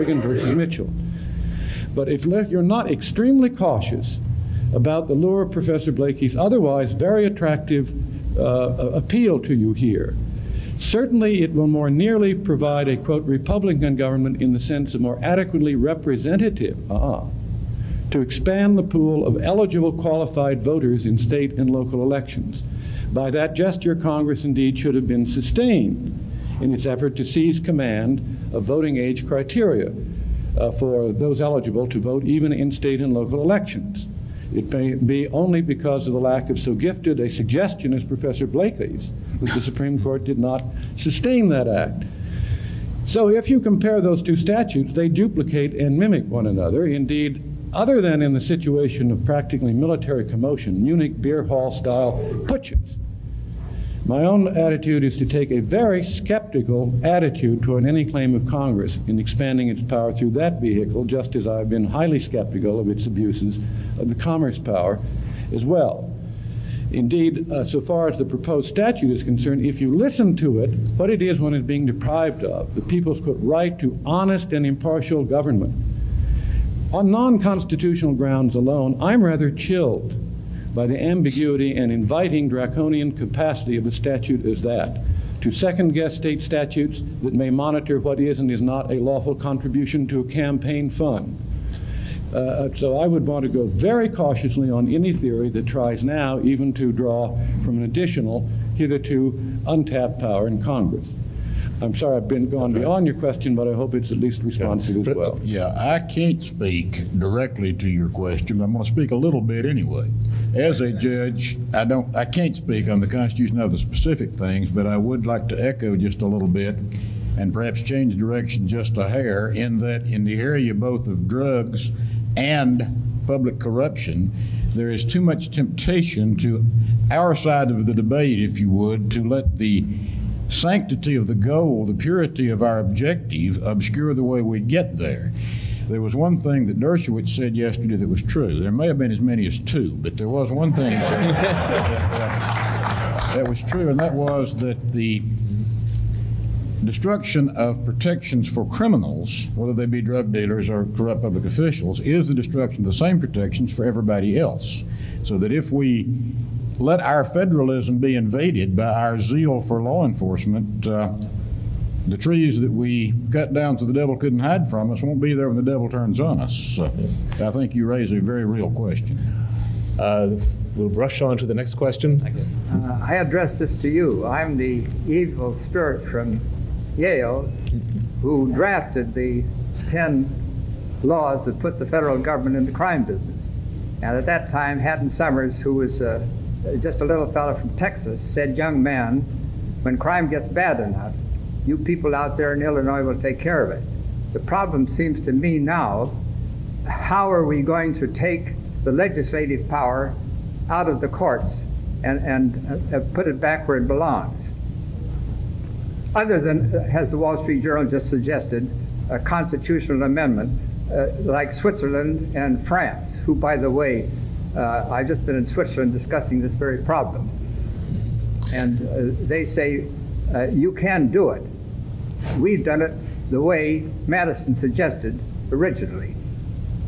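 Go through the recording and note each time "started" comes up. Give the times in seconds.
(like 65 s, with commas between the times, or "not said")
not said.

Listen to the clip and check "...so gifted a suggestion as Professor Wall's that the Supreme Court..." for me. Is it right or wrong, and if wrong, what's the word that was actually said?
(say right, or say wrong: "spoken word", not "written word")
wrong: "Blakey", not "Wall".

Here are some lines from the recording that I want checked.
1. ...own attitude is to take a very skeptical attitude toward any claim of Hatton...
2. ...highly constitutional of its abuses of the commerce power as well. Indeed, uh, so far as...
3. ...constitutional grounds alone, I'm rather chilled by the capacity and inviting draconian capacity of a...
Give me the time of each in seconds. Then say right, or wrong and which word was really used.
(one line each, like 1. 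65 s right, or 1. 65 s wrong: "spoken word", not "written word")
1. 54 s wrong: "Congress", not "Hatton"
2. 61 s wrong: "skeptical", not "constitutional"
3. 77 s wrong: "ambiguity", not "capacity".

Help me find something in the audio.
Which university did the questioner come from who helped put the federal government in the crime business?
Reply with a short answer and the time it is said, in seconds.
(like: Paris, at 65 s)
Yale, at 176 s.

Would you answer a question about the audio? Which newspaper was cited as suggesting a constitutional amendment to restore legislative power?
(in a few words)
The Wall Street Journal.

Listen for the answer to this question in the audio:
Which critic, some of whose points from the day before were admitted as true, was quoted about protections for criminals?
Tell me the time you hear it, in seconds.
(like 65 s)
136 s.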